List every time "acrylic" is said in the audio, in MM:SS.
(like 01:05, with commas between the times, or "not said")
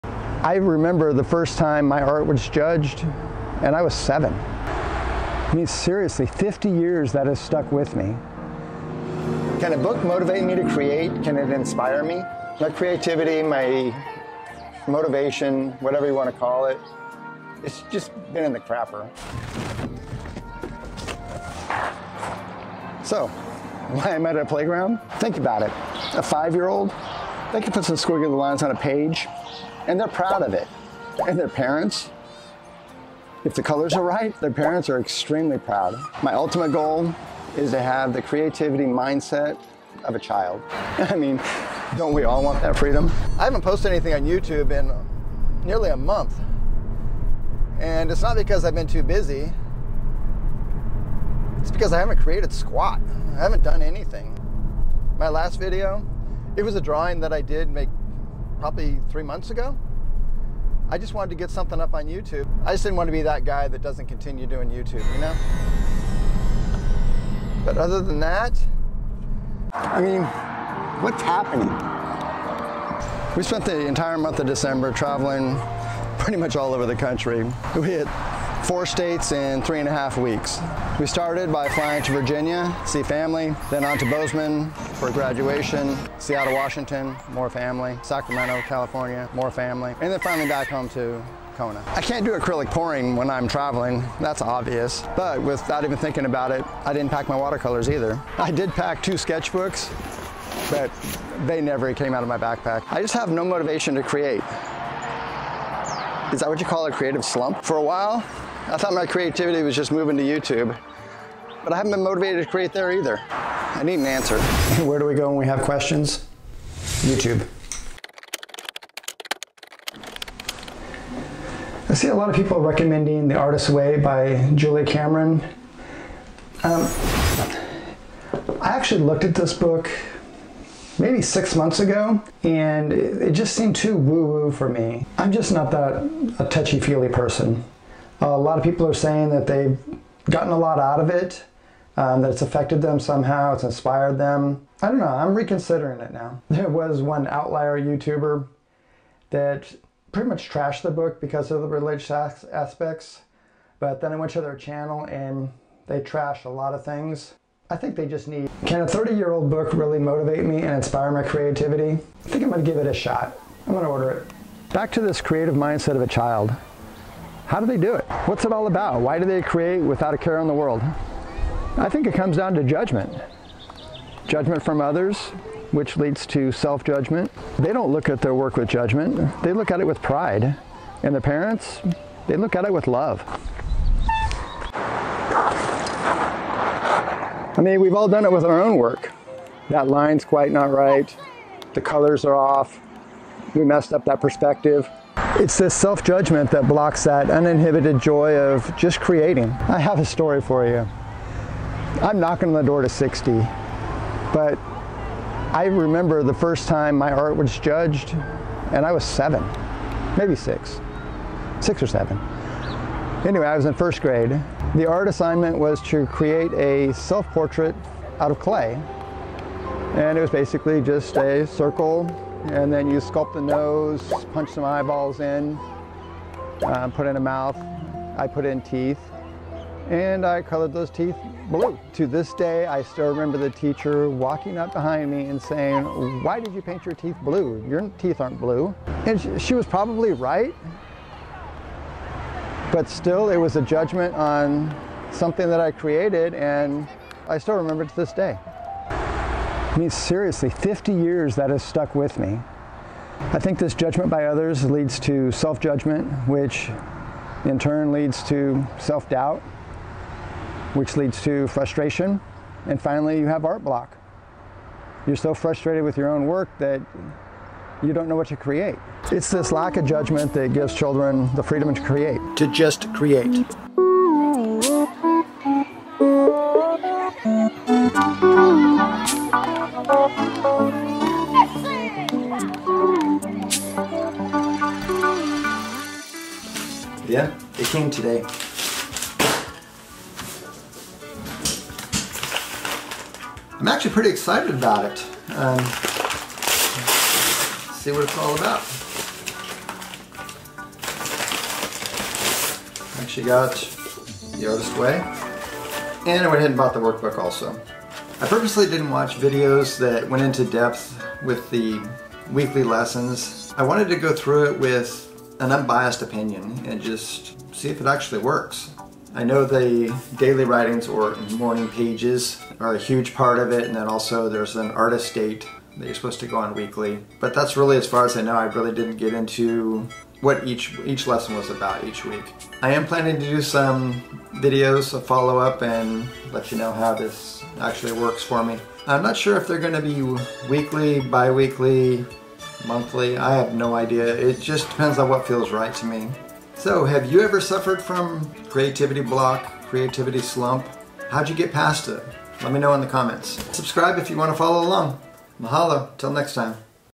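01:32.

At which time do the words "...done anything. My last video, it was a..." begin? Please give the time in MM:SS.
00:53.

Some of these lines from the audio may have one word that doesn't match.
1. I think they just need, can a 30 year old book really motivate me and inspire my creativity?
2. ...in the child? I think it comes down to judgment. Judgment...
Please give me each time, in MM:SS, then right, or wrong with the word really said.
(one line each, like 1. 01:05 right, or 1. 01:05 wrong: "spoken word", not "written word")
1. 02:37 right
2. 02:50 wrong: "world", not "child".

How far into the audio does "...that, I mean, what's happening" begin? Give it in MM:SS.
01:08.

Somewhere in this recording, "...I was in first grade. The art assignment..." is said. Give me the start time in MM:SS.
03:33.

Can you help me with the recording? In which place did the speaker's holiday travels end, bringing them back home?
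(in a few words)
Kona.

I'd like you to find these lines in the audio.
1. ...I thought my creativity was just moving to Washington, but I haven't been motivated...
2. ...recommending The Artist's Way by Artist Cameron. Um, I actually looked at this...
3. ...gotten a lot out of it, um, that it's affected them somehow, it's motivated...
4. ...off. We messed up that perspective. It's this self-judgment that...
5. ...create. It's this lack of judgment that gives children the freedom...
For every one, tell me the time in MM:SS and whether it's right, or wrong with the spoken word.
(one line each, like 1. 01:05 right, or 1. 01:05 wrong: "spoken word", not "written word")
1. 01:48 wrong: "YouTube", not "Washington"
2. 02:02 wrong: "Julia", not "Artist"
3. 02:20 wrong: "inspired", not "motivated"
4. 03:12 right
5. 04:28 right.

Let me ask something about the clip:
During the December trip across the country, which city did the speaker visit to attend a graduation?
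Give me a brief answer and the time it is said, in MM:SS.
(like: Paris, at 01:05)
Bozeman, at 01:24.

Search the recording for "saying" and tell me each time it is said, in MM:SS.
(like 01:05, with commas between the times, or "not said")
02:18, 03:55.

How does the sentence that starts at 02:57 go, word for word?
They don't look at their work with judgment.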